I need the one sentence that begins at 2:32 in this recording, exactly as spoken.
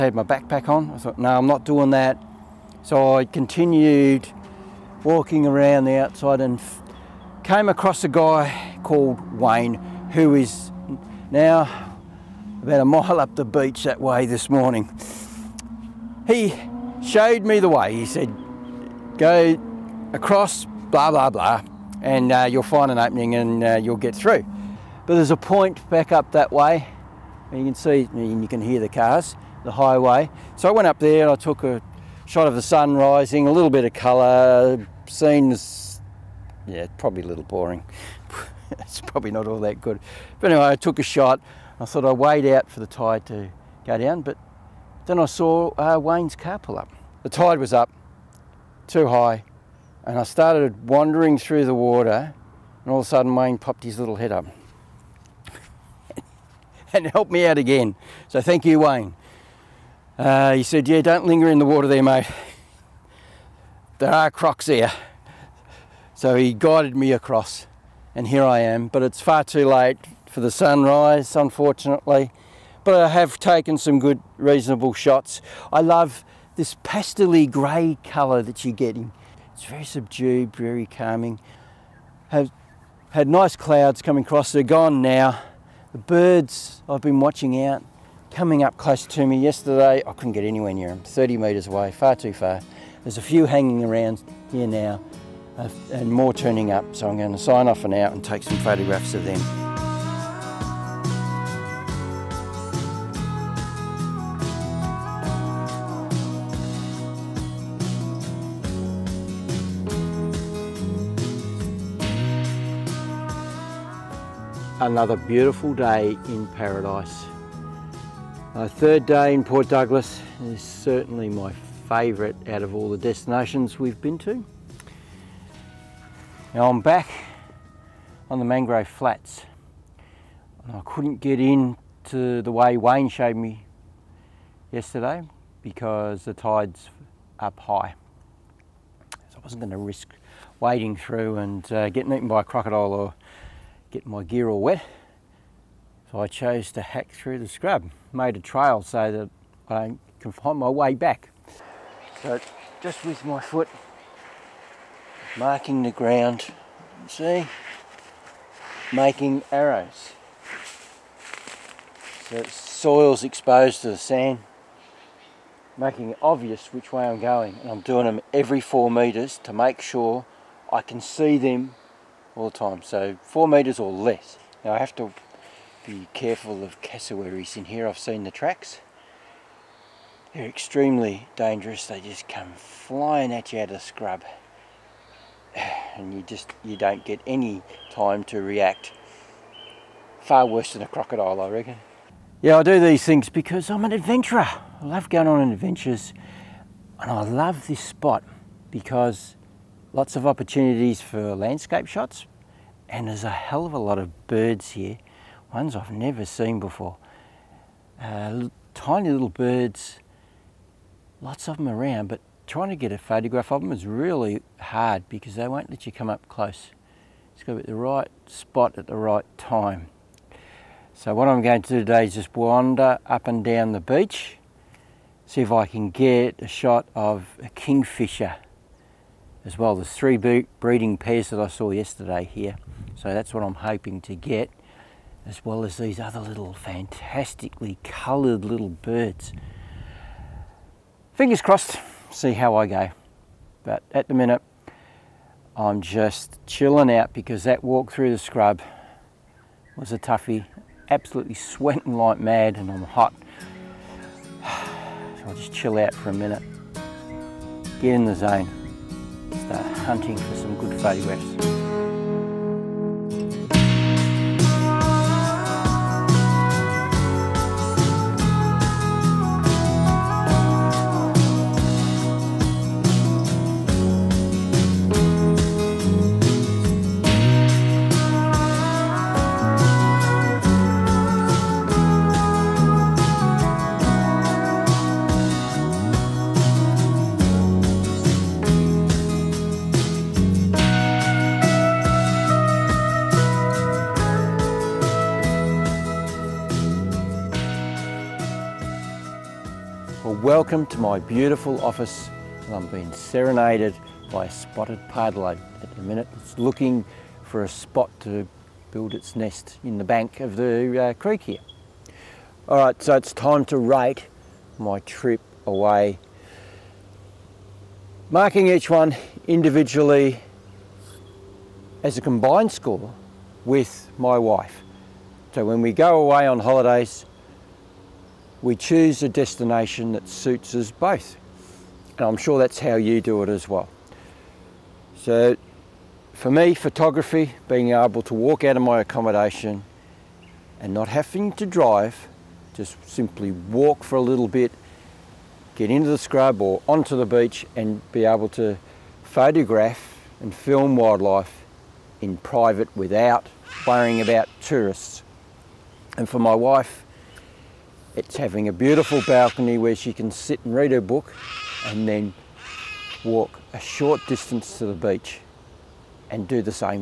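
So just with my foot, marking the ground, see, making arrows.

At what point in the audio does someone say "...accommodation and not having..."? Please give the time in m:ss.
5:38.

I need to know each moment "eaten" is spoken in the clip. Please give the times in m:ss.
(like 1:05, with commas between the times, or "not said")
2:22.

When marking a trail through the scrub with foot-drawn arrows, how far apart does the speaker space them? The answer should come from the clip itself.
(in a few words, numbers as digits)
4 metres.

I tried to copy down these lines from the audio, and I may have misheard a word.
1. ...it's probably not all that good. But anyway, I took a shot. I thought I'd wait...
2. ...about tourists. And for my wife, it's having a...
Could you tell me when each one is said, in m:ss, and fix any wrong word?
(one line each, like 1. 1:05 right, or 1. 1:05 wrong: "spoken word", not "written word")
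1. 0:38 right
2. 5:54 right.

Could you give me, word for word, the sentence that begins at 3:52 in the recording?
So that's what I'm hoping to get as well as these other little fantastically coloured little birds.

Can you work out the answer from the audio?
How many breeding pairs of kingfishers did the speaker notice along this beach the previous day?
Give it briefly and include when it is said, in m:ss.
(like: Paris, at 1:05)
3, at 3:49.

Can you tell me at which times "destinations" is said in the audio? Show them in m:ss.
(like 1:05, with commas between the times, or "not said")
2:02, 5:29.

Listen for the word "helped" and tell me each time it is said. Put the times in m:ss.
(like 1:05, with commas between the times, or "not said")
0:57.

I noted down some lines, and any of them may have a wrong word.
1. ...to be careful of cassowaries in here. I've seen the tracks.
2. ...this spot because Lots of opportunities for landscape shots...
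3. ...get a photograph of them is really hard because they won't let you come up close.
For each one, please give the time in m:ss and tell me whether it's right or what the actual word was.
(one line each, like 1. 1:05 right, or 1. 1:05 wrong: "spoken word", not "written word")
1. 2:54 right
2. 3:17 right
3. 3:32 right.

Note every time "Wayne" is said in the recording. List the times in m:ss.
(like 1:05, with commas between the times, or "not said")
0:09, 0:45, 0:53, 0:58, 2:12.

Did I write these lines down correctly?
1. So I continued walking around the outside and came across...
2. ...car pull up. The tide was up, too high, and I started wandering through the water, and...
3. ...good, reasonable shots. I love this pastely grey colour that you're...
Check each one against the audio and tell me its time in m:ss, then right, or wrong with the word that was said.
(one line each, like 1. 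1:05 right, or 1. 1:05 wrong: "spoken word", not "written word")
1. 0:02 right
2. 0:46 right
3. 1:13 right.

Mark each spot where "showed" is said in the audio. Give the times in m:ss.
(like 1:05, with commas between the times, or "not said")
0:17, 2:13.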